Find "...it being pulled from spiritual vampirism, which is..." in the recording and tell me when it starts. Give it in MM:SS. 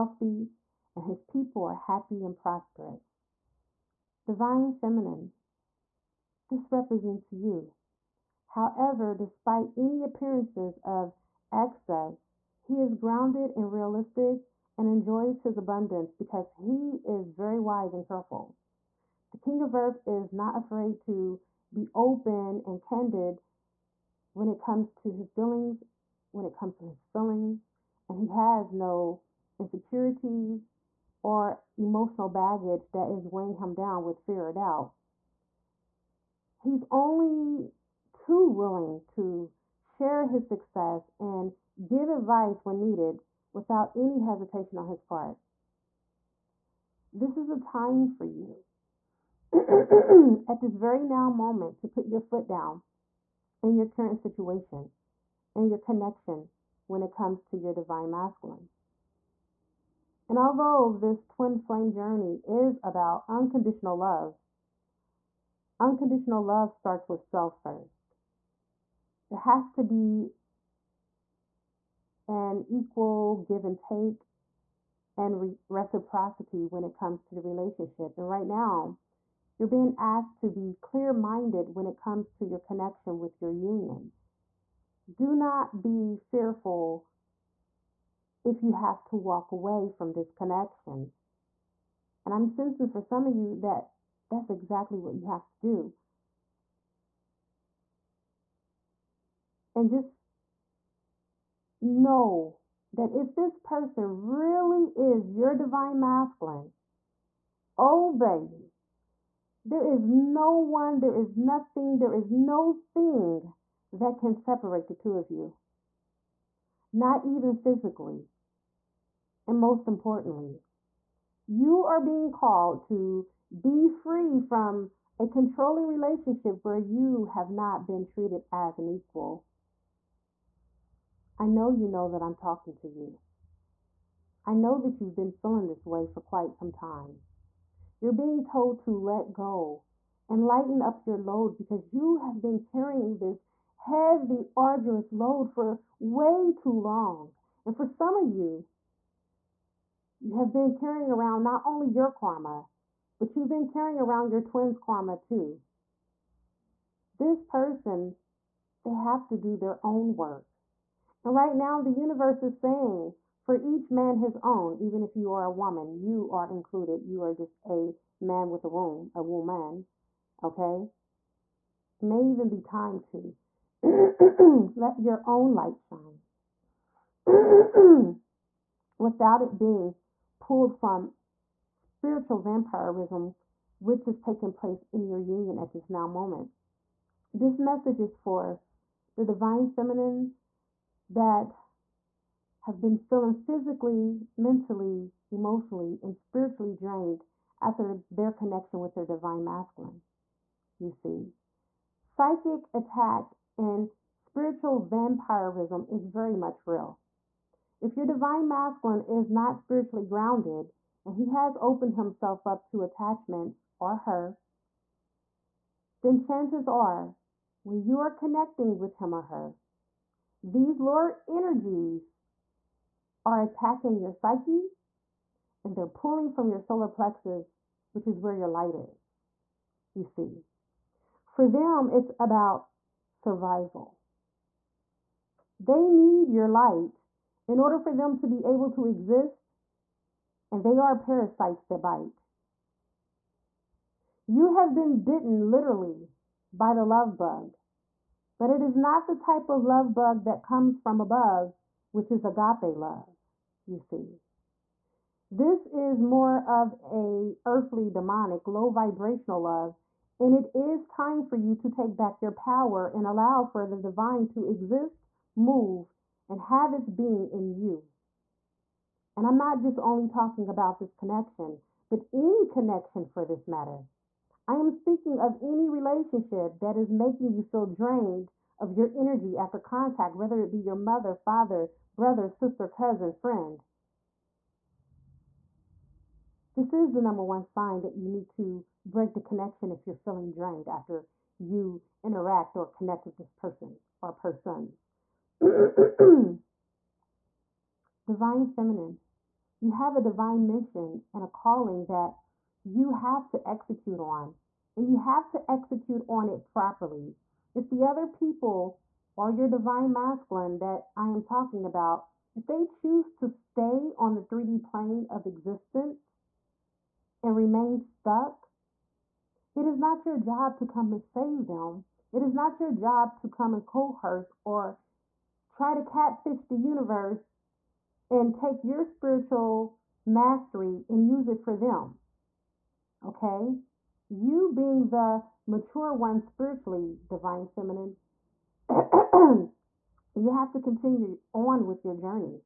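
02:59.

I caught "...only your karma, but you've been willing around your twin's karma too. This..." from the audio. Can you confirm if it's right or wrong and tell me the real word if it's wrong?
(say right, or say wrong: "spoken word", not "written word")
wrong: "carrying", not "willing".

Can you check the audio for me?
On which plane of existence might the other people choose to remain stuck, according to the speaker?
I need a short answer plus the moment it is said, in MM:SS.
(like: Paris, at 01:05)
3D, at 05:14.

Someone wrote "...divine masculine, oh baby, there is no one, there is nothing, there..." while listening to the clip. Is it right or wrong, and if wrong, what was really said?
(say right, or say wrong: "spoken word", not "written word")
right.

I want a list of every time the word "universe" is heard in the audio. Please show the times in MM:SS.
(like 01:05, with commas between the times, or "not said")
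02:41, 05:26.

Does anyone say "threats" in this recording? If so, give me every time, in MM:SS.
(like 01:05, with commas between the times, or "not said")
not said.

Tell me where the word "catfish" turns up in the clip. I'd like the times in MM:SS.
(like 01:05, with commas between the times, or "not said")
05:25.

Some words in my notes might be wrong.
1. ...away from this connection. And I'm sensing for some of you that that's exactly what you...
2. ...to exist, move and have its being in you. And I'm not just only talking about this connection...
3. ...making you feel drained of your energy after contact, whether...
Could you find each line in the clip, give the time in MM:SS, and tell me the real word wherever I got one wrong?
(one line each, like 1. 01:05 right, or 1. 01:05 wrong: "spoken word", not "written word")
1. 01:29 right
2. 04:24 right
3. 04:36 right.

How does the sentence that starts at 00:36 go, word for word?
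He's only too willing to share his success and give advice when needed without any hesitation on his part.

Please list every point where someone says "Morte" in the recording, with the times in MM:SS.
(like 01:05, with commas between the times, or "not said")
not said.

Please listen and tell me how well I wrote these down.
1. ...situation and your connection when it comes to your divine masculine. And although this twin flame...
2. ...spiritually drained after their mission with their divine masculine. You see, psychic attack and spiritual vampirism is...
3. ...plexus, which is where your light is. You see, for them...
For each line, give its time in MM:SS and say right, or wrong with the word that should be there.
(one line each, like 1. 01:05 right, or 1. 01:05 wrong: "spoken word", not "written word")
1. 00:54 right
2. 03:16 wrong: "connection", not "mission"
3. 03:46 right.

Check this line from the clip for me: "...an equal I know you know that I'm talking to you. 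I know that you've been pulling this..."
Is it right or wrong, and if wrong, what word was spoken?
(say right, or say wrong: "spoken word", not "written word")
wrong: "feeling", not "pulling".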